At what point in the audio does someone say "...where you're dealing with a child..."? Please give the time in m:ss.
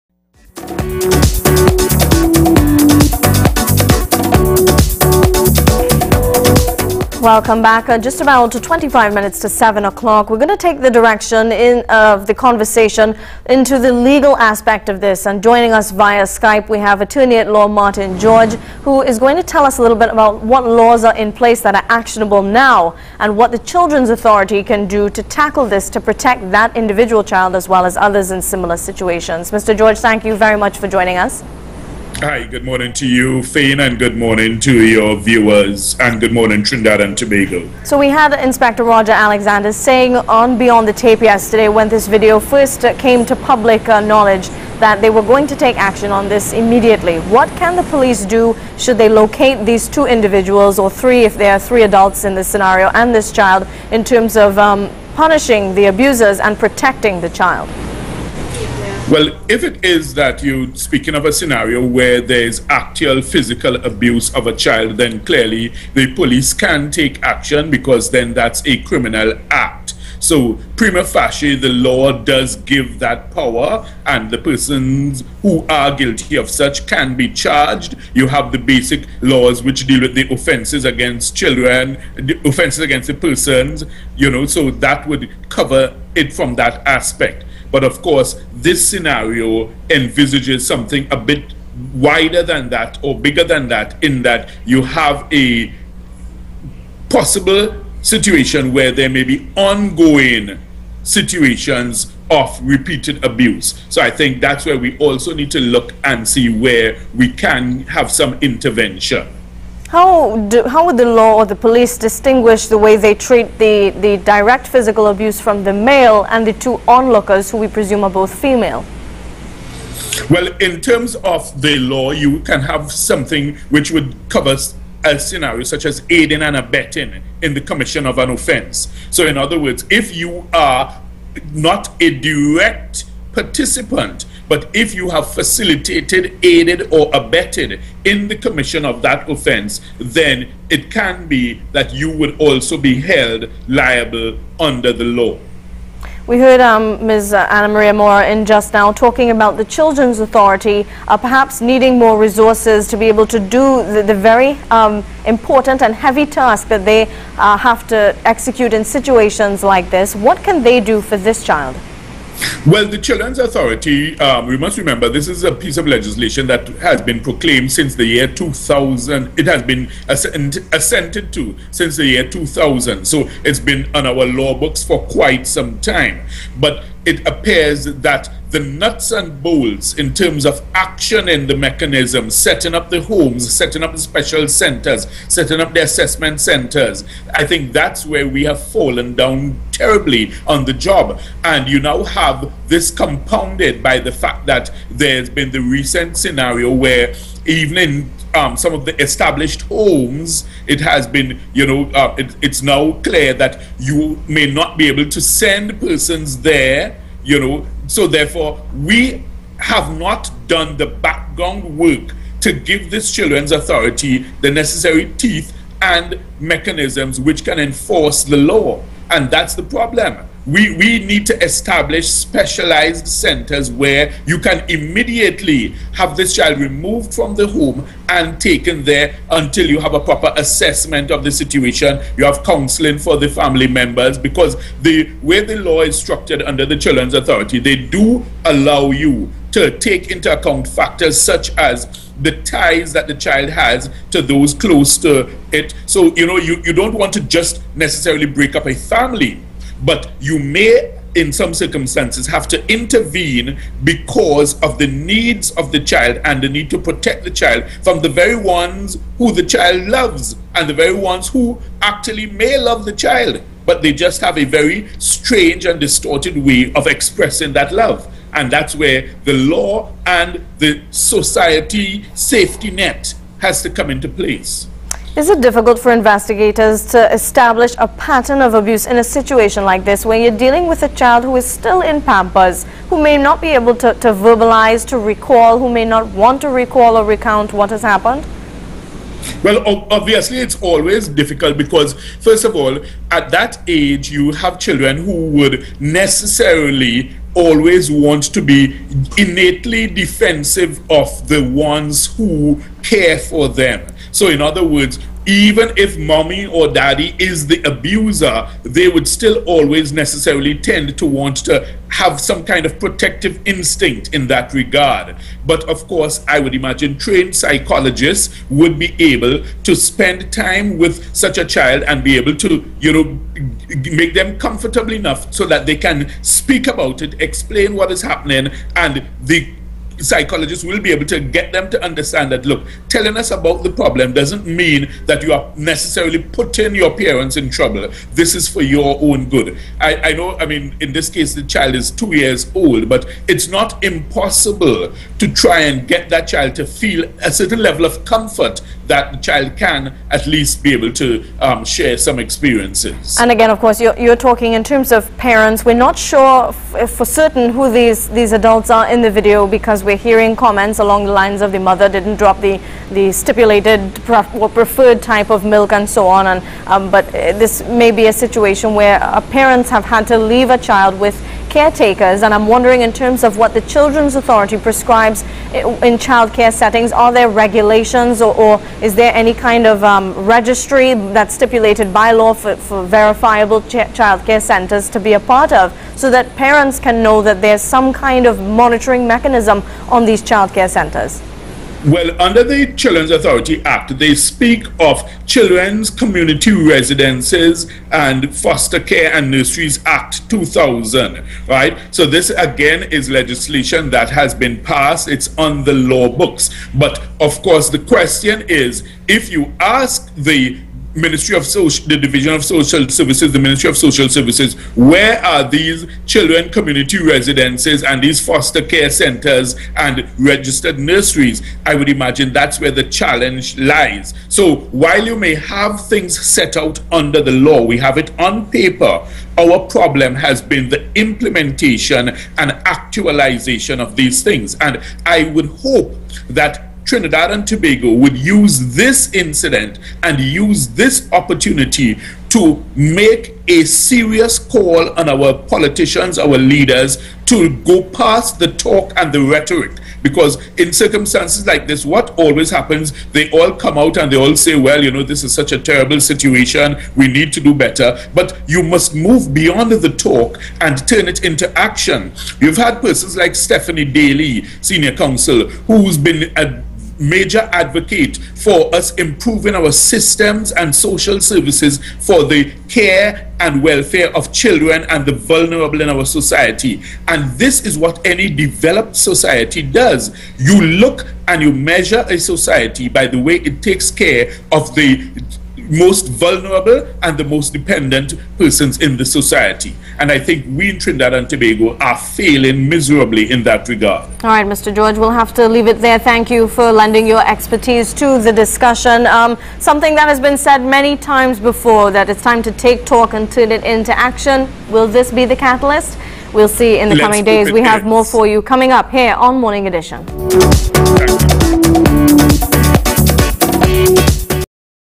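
4:40.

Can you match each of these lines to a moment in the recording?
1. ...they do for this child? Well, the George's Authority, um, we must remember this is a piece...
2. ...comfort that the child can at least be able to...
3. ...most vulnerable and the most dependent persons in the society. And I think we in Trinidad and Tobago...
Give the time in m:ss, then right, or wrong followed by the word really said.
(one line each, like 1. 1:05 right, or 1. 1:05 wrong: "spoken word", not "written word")
1. 2:40 wrong: "Children", not "George"
2. 5:48 right
3. 8:05 right.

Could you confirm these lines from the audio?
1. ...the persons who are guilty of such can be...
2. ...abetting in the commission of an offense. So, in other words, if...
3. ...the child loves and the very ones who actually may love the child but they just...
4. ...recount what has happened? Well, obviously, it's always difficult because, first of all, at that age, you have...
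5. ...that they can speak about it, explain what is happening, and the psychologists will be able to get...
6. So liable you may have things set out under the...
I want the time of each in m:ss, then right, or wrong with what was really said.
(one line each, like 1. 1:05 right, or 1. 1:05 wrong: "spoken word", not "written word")
1. 1:14 right
2. 2:06 right
3. 4:19 right
4. 4:47 right
5. 5:25 right
6. 7:04 wrong: "while", not "liable".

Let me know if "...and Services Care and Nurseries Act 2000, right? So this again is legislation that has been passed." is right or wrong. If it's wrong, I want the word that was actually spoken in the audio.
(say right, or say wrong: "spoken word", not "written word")
wrong: "Foster", not "Services".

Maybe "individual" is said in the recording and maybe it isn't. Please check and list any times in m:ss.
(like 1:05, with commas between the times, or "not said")
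0:26, 0:50.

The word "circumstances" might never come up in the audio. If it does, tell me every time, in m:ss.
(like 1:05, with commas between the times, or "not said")
4:11, 7:30.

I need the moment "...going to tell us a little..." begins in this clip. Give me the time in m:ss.
0:19.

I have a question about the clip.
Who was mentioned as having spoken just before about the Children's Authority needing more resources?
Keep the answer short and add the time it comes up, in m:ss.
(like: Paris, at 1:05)
Anna Maria Moore, at 2:27.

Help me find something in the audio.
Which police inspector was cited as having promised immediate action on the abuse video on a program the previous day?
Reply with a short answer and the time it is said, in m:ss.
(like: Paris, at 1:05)
Roger Alexander, at 0:38.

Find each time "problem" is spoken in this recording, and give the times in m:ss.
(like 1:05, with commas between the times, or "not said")
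3:39, 5:33, 7:09.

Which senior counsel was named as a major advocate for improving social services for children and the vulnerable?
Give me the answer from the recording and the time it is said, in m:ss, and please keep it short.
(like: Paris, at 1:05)
Stephanie Daly, at 7:43.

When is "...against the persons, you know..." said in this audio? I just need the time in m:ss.
1:22.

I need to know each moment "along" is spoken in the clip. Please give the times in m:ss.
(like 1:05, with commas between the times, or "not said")
6:00.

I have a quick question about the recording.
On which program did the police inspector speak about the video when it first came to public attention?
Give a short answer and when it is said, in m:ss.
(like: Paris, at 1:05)
Beyond the Tape, at 0:40.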